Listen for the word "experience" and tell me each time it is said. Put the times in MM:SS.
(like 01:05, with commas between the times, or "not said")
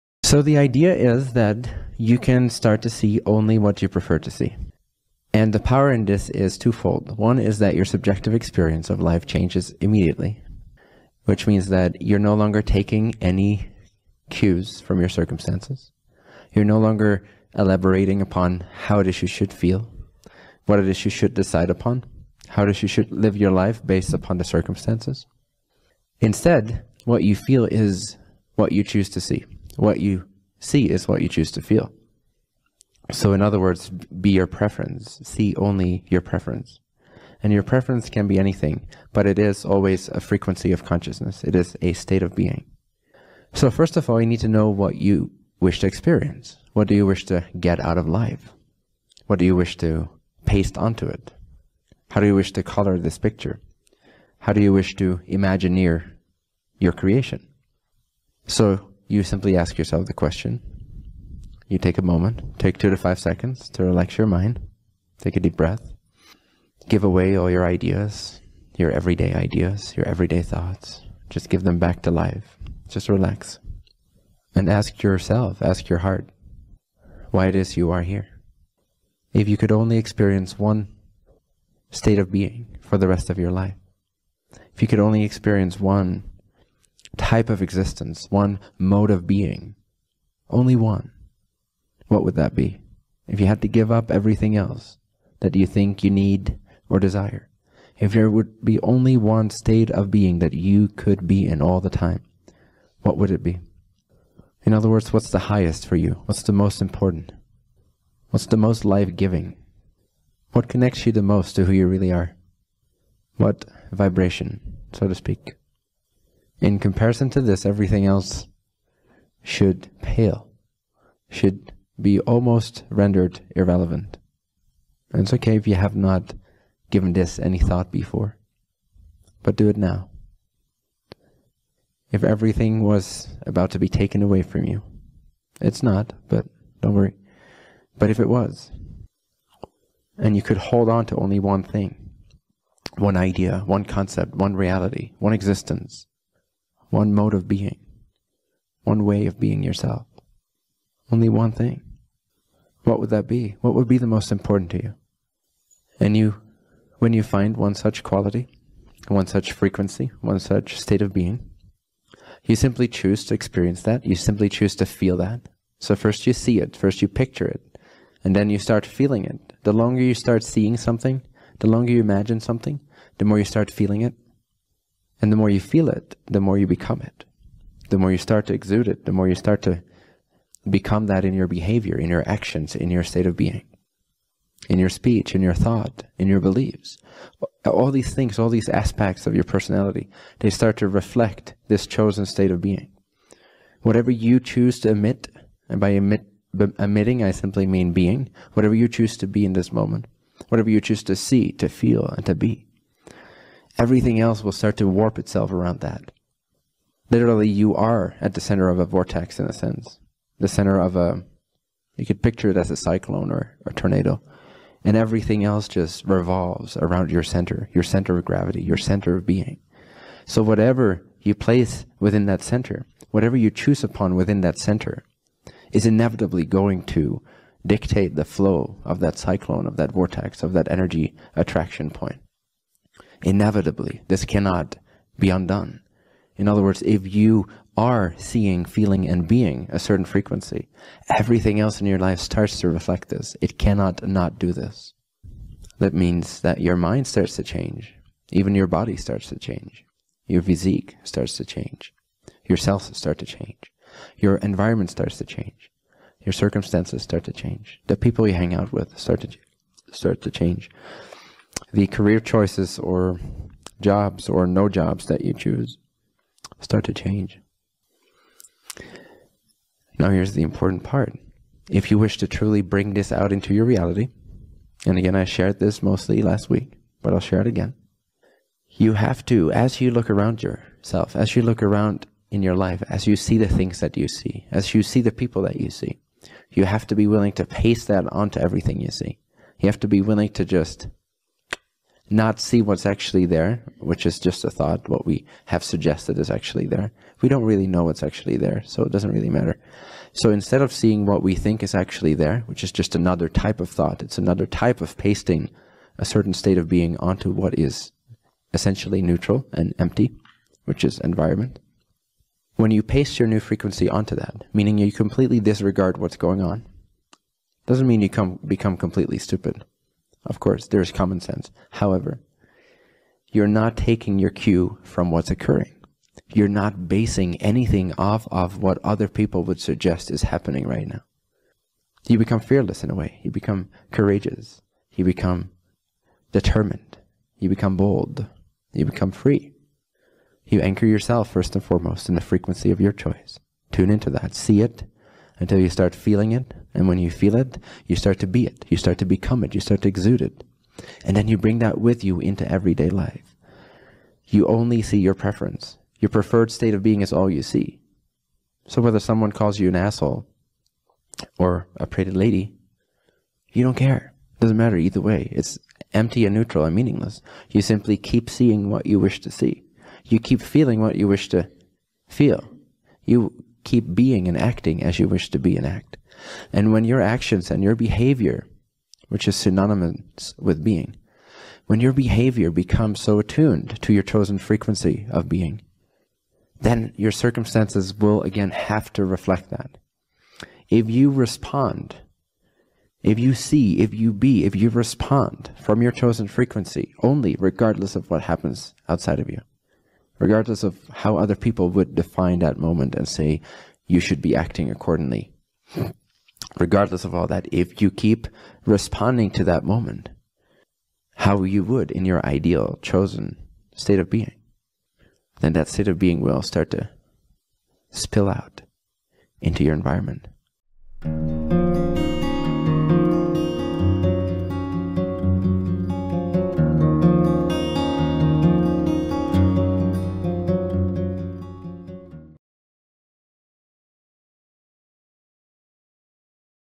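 00:08, 00:45, 01:19, 01:25, 02:43.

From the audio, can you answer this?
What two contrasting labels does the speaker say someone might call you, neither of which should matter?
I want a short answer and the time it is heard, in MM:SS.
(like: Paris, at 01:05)
an asshole or a pretty lady, at 05:59.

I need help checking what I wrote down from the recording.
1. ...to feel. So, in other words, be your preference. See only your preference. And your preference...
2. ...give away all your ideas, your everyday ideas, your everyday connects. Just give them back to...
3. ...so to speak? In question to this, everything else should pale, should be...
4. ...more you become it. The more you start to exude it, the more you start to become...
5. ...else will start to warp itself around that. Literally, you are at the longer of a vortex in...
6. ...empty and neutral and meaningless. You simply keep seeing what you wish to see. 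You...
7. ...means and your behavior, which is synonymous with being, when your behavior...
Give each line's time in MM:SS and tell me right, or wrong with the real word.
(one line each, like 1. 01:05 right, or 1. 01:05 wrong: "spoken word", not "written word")
1. 00:31 right
2. 01:06 wrong: "thoughts", not "connects"
3. 01:54 wrong: "comparison", not "question"
4. 02:56 right
5. 03:24 wrong: "center", not "longer"
6. 06:05 right
7. 06:17 wrong: "actions", not "means".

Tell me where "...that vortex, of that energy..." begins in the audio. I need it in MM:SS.
03:49.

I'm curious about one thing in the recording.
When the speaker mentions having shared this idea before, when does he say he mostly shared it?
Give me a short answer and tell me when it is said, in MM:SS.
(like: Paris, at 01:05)
last week, at 04:36.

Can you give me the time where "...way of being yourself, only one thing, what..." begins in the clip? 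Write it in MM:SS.
02:29.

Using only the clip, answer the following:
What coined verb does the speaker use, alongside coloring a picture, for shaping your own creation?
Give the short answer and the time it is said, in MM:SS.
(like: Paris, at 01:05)
imagineer, at 00:55.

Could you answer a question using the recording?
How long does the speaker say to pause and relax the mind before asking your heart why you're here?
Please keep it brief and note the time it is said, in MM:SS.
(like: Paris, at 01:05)
2 to 5 seconds, at 01:02.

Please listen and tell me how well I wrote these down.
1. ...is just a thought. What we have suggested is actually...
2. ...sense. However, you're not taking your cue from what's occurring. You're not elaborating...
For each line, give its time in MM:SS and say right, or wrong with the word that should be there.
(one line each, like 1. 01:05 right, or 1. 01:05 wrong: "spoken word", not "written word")
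1. 04:54 right
2. 05:21 wrong: "basing", not "elaborating".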